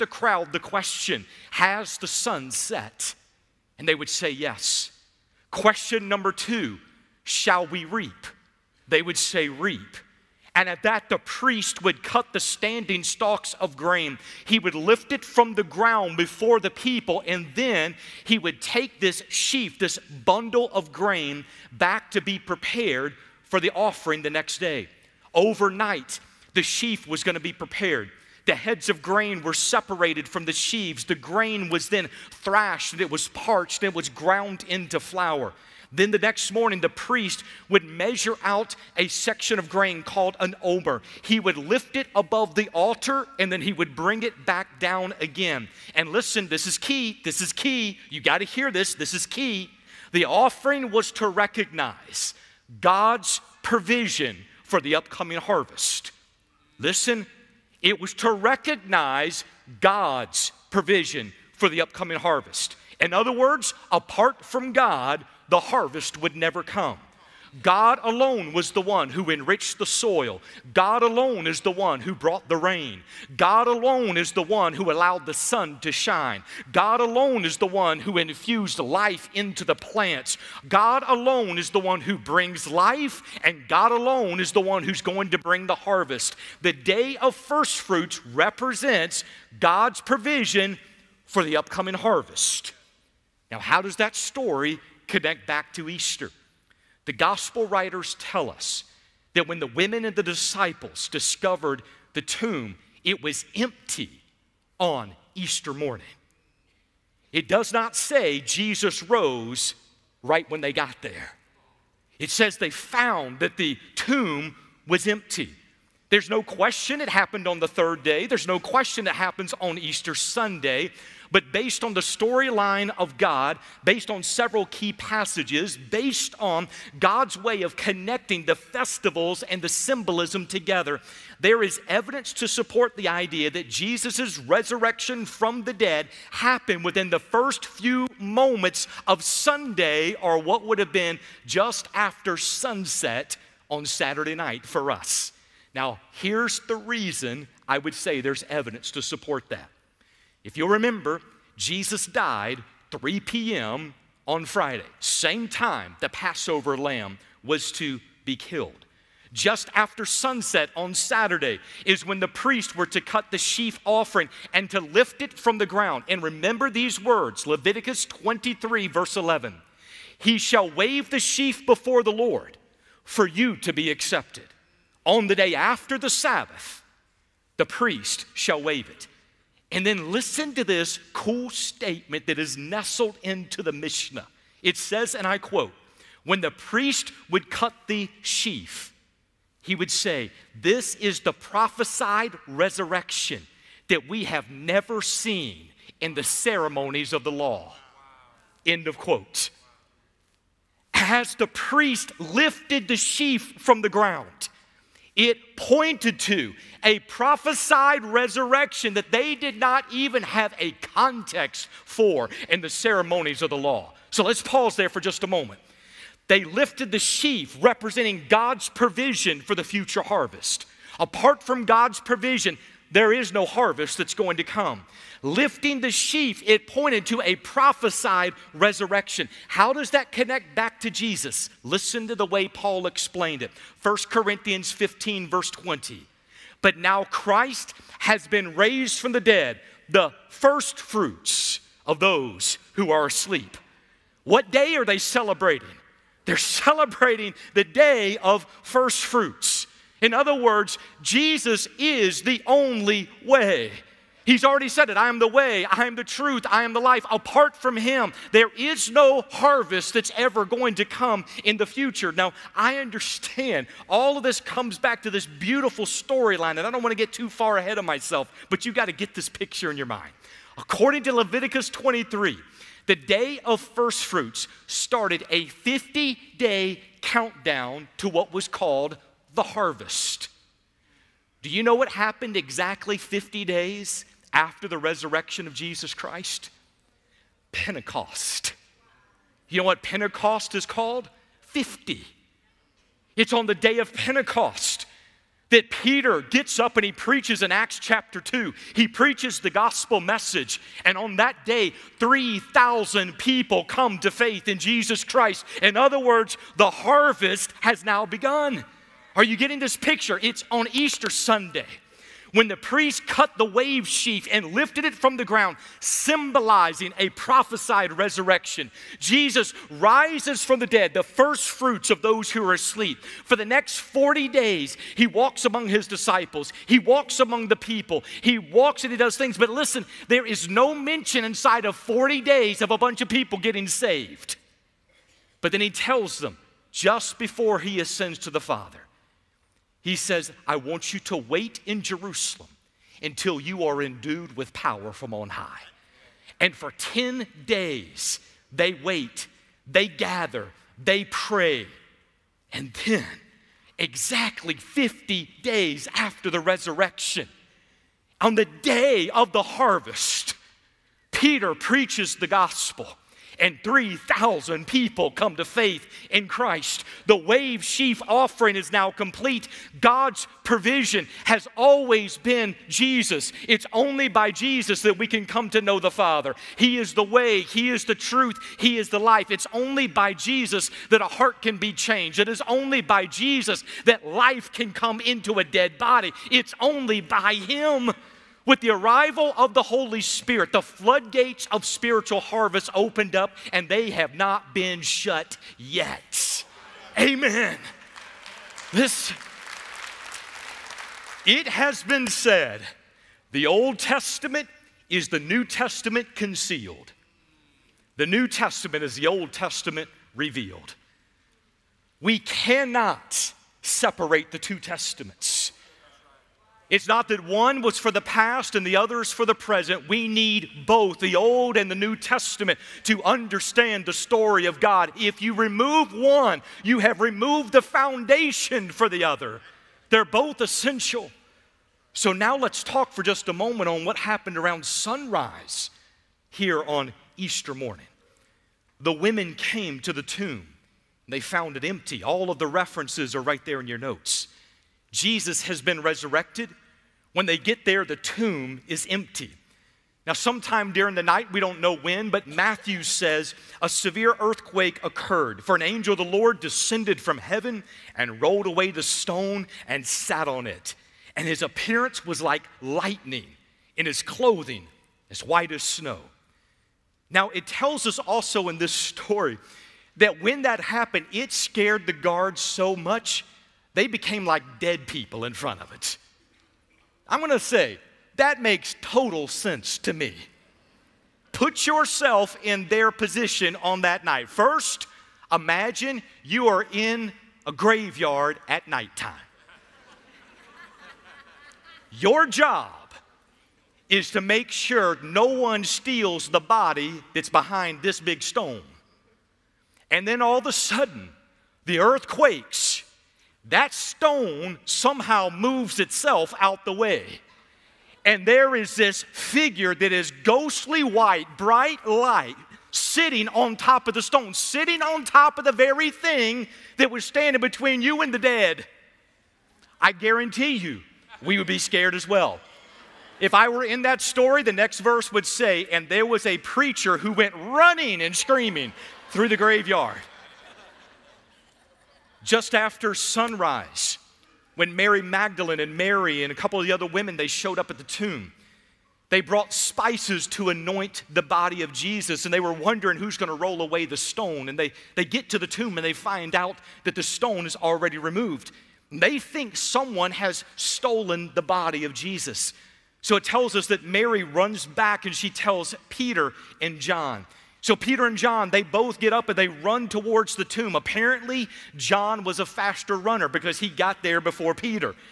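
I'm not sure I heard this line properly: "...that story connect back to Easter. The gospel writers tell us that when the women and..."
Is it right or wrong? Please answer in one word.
right.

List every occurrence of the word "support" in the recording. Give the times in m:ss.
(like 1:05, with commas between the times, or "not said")
2:12, 2:29.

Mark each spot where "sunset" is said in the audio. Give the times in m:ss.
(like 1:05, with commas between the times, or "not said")
2:22, 2:40.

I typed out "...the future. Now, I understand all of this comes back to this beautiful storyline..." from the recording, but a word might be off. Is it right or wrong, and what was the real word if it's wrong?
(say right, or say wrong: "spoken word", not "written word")
right.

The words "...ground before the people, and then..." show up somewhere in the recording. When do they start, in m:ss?
0:15.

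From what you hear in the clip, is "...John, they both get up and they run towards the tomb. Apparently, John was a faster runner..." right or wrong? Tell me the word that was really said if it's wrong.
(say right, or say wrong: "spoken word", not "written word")
right.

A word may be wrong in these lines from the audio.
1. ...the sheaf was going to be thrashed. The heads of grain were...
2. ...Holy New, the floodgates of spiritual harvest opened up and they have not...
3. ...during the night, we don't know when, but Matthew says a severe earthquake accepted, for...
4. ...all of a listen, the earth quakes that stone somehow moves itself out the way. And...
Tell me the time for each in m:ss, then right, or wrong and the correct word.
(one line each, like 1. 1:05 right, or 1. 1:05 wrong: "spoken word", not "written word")
1. 0:26 wrong: "prepared", not "thrashed"
2. 6:29 wrong: "Spirit", not "New"
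3. 7:30 wrong: "occurred", not "accepted"
4. 8:20 wrong: "sudden", not "listen".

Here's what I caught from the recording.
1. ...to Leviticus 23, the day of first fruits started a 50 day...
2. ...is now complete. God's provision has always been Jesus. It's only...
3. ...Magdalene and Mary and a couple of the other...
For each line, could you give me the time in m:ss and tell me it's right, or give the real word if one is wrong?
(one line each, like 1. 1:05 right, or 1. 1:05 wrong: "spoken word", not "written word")
1. 4:31 right
2. 6:08 right
3. 8:55 right.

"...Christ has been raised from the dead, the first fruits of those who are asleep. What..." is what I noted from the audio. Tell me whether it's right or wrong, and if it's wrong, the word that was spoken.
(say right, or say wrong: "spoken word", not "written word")
right.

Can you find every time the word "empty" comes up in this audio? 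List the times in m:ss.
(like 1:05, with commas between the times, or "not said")
1:43, 1:55, 7:21, 7:28.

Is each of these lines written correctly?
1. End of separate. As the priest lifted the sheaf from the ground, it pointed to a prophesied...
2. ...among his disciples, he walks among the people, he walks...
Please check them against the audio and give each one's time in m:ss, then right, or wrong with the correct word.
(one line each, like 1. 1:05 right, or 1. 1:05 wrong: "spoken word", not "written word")
1. 3:18 wrong: "quote", not "separate"
2. 5:25 right.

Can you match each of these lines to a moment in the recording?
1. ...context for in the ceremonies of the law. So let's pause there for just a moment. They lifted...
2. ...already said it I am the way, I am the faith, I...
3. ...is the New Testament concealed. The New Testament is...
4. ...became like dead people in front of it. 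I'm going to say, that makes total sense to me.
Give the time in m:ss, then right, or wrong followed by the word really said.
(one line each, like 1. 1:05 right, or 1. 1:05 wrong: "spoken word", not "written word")
1. 3:30 right
2. 4:14 wrong: "truth", not "faith"
3. 6:44 right
4. 7:53 right.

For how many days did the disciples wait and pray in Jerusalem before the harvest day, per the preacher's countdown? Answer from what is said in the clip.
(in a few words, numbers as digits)
10.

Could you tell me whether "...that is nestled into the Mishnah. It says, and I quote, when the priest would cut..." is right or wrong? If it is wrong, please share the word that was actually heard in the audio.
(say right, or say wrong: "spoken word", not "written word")
right.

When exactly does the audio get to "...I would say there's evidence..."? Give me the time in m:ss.
2:27.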